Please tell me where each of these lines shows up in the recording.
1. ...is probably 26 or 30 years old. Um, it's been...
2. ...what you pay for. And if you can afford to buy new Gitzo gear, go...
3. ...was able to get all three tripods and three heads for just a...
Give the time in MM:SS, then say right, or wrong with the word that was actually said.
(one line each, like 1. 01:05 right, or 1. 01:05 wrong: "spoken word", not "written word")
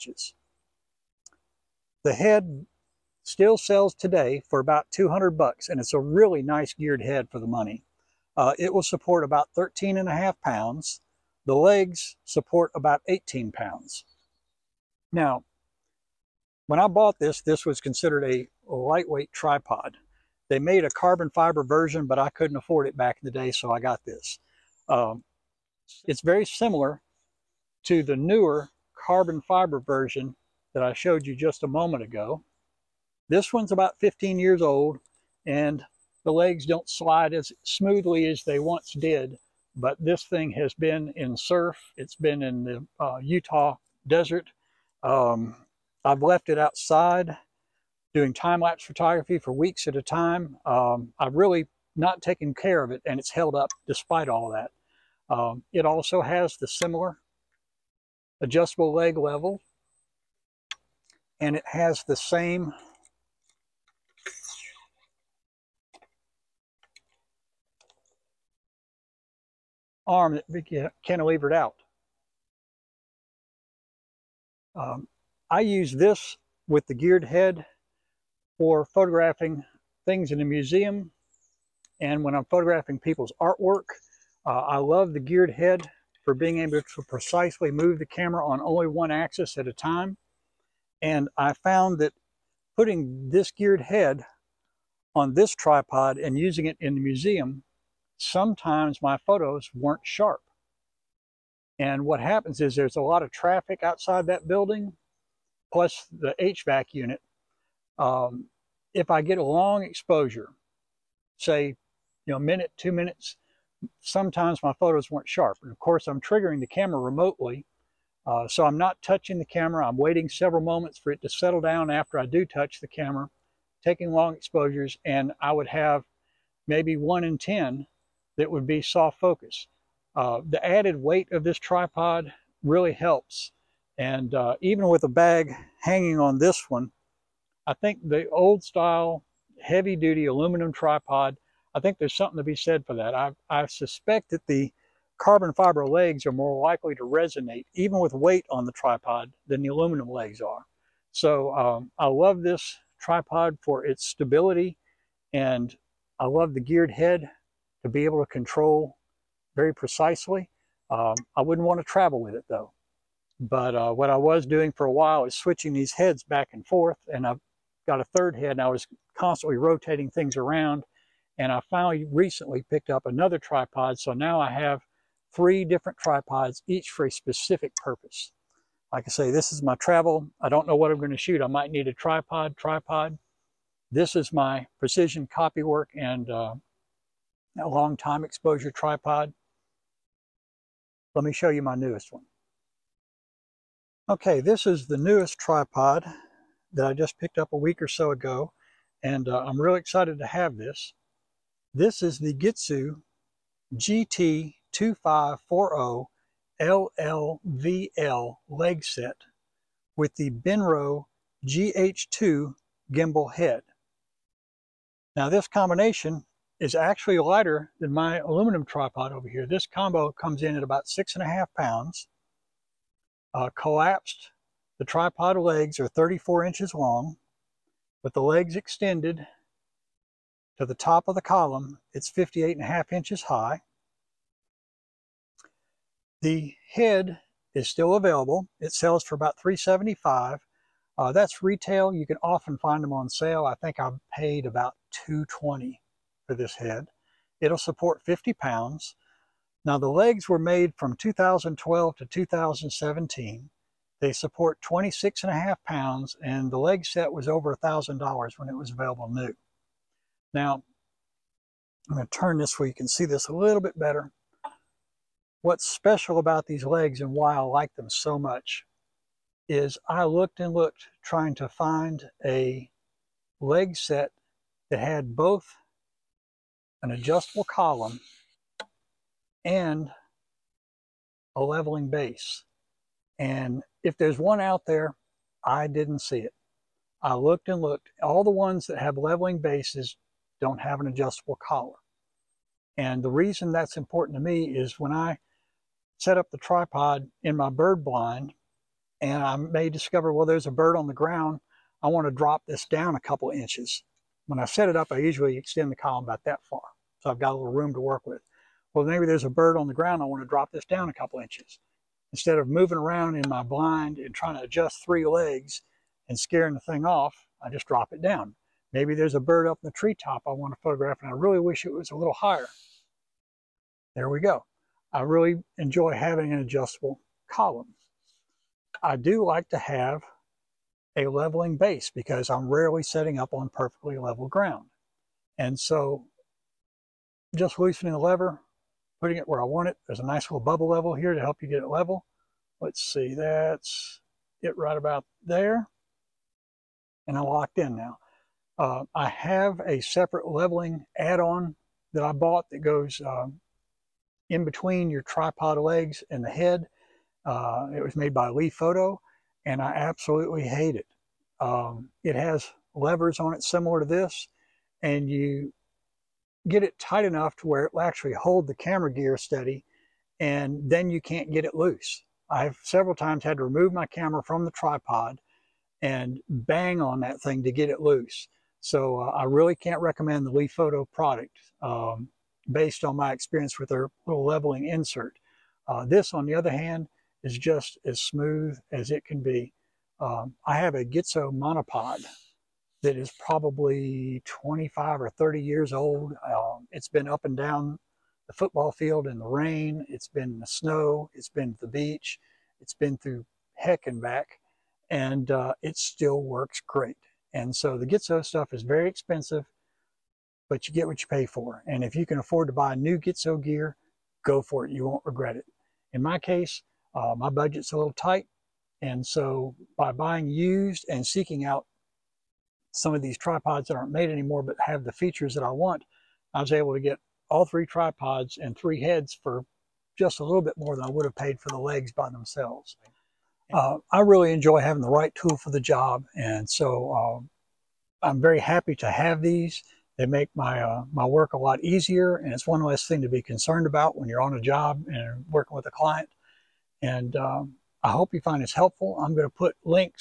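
1. 06:32 wrong: "25", not "26"
2. 06:50 right
3. 07:06 right.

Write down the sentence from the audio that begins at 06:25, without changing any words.
Uh, this, on the other hand, is just as smooth as it can be.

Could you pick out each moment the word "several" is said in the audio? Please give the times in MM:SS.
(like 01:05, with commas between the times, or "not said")
02:00, 06:12.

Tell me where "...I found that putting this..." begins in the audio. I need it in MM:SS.
01:31.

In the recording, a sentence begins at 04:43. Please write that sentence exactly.
And if there's one out there, I didn't see it.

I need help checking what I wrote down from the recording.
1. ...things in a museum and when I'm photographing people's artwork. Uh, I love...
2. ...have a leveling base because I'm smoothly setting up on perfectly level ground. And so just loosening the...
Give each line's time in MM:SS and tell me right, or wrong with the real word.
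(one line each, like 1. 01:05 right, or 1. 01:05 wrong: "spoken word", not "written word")
1. 01:20 right
2. 05:29 wrong: "rarely", not "smoothly".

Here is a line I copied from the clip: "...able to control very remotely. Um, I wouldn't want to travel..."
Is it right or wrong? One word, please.
wrong.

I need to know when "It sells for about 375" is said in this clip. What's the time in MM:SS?
03:58.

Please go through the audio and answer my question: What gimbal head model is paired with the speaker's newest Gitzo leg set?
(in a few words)
Benro GH2.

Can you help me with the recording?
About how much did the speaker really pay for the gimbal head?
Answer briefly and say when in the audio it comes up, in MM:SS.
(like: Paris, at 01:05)
$220, at 04:05.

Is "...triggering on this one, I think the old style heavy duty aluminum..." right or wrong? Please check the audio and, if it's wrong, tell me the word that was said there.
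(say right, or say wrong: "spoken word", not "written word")
wrong: "hanging", not "triggering".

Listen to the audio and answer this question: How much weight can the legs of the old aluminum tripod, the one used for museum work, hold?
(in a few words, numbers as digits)
18 pounds.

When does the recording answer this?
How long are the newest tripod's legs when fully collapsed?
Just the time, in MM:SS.
03:45.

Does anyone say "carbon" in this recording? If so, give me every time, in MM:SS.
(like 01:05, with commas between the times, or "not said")
00:20, 00:28, 02:25.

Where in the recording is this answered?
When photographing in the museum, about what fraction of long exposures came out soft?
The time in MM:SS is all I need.
02:06.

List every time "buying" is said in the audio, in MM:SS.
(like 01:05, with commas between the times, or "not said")
06:59.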